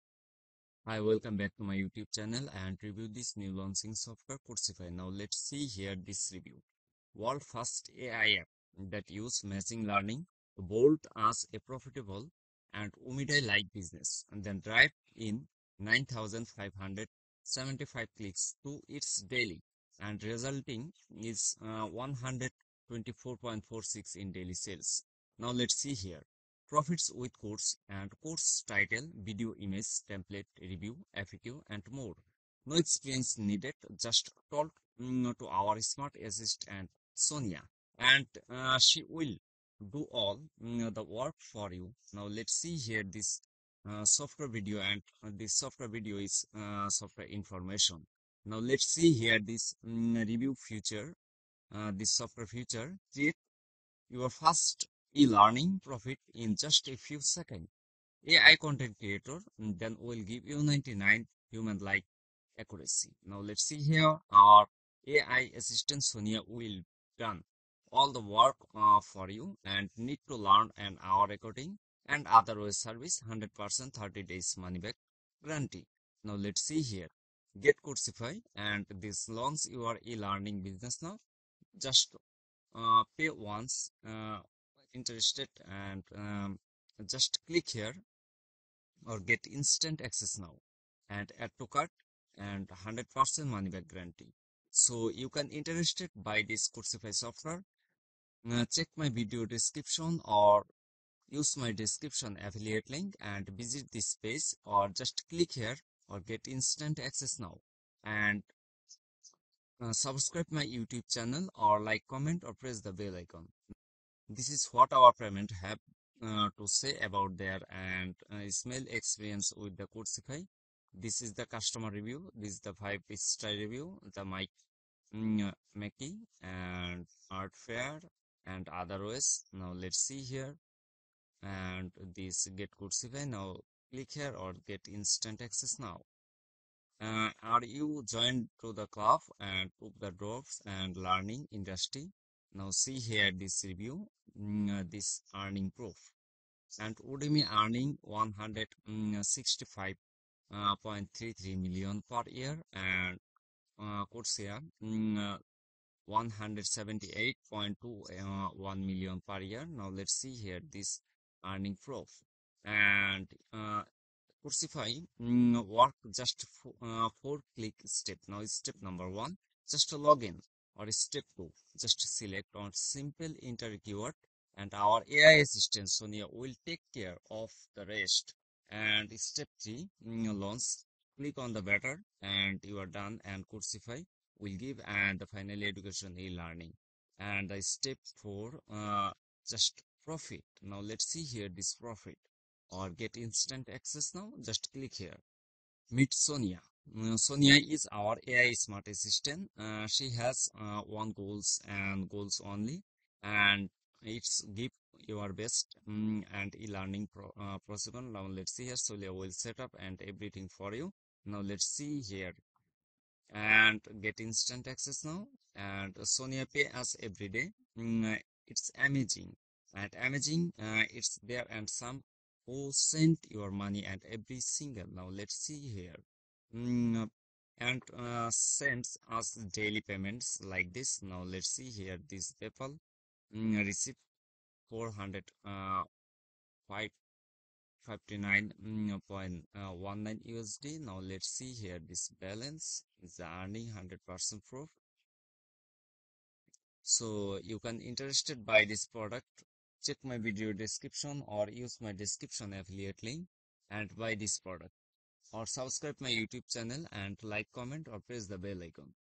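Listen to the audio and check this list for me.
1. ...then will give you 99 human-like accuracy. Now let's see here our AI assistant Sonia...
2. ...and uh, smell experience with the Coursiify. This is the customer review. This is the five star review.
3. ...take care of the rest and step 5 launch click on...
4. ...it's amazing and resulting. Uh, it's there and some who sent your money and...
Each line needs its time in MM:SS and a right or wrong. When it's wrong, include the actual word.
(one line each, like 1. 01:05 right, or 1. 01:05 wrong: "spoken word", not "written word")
1. 00:59 right
2. 01:57 right
3. 02:56 wrong: "3", not "5"
4. 03:38 wrong: "amazing", not "resulting".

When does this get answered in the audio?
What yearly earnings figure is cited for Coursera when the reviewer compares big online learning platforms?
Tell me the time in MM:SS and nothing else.
02:36.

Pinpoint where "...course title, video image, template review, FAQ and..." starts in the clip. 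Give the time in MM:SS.
00:28.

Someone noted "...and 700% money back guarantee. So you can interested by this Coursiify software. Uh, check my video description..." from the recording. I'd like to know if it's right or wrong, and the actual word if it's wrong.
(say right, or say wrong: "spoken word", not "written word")
wrong: "100", not "700".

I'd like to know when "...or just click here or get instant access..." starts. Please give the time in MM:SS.
01:44.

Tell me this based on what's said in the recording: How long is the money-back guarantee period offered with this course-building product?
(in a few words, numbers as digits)
30 days.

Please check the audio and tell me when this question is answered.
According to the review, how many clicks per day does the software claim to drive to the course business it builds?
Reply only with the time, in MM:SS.
00:15.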